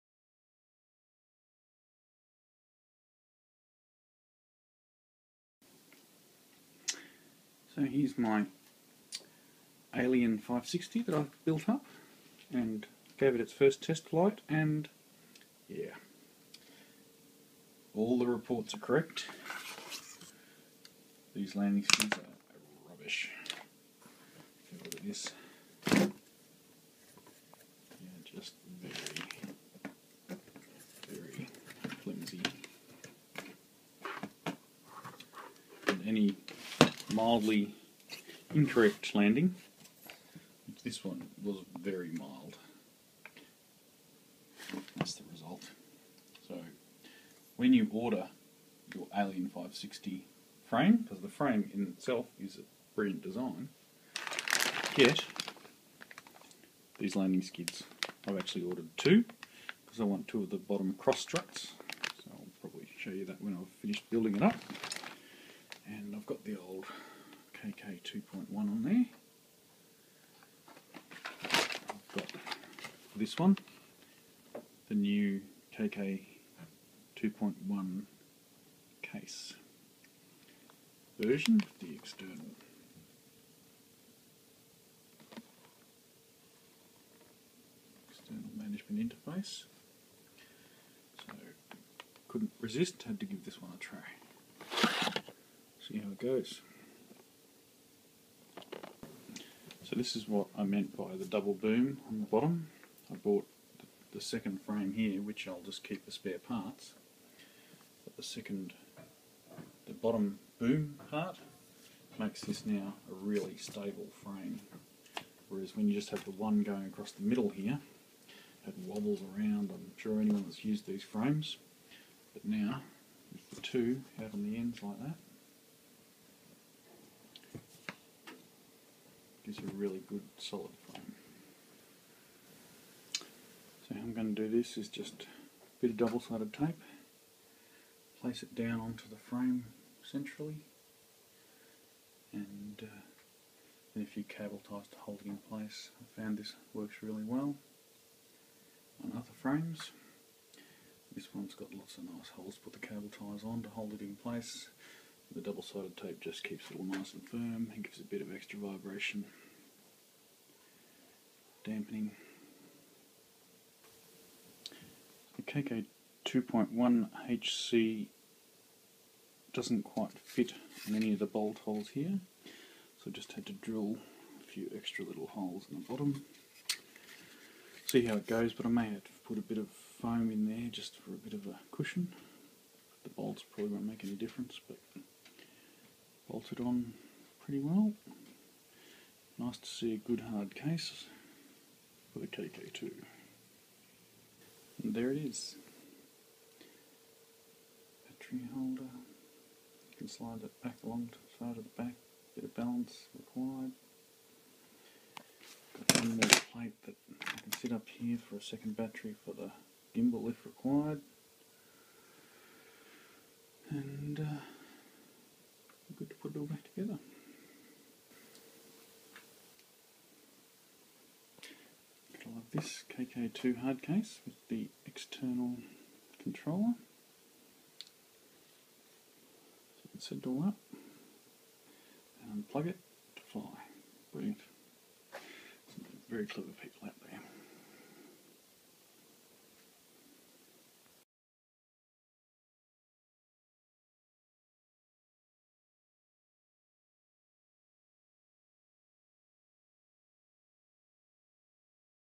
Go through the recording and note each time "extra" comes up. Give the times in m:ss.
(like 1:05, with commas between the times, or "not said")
2:38, 2:54.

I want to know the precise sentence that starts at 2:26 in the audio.
I found this works really well on other frames.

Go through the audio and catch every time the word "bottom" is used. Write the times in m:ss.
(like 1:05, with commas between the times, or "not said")
1:00, 1:42, 1:49, 2:55.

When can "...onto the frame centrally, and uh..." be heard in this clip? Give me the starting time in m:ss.
2:18.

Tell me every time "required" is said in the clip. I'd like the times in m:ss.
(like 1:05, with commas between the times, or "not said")
3:23, 3:30.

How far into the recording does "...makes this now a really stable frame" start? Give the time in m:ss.
1:52.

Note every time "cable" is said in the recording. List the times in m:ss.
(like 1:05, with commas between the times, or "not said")
2:24, 2:32.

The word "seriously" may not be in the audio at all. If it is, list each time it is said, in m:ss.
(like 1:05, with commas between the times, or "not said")
not said.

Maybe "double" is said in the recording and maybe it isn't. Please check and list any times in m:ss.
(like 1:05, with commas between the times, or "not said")
1:41, 2:15, 2:35.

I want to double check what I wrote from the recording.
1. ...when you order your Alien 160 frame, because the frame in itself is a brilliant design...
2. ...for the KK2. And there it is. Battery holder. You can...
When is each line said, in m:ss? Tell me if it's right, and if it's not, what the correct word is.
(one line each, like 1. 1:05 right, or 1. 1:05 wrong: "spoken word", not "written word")
1. 0:47 wrong: "560", not "160"
2. 3:12 right.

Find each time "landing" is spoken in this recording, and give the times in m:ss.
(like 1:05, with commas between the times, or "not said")
0:21, 0:39, 0:57.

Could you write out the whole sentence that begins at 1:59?
I'm sure anyone that's used these frames.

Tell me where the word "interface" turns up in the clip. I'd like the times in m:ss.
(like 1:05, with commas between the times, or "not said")
1:29.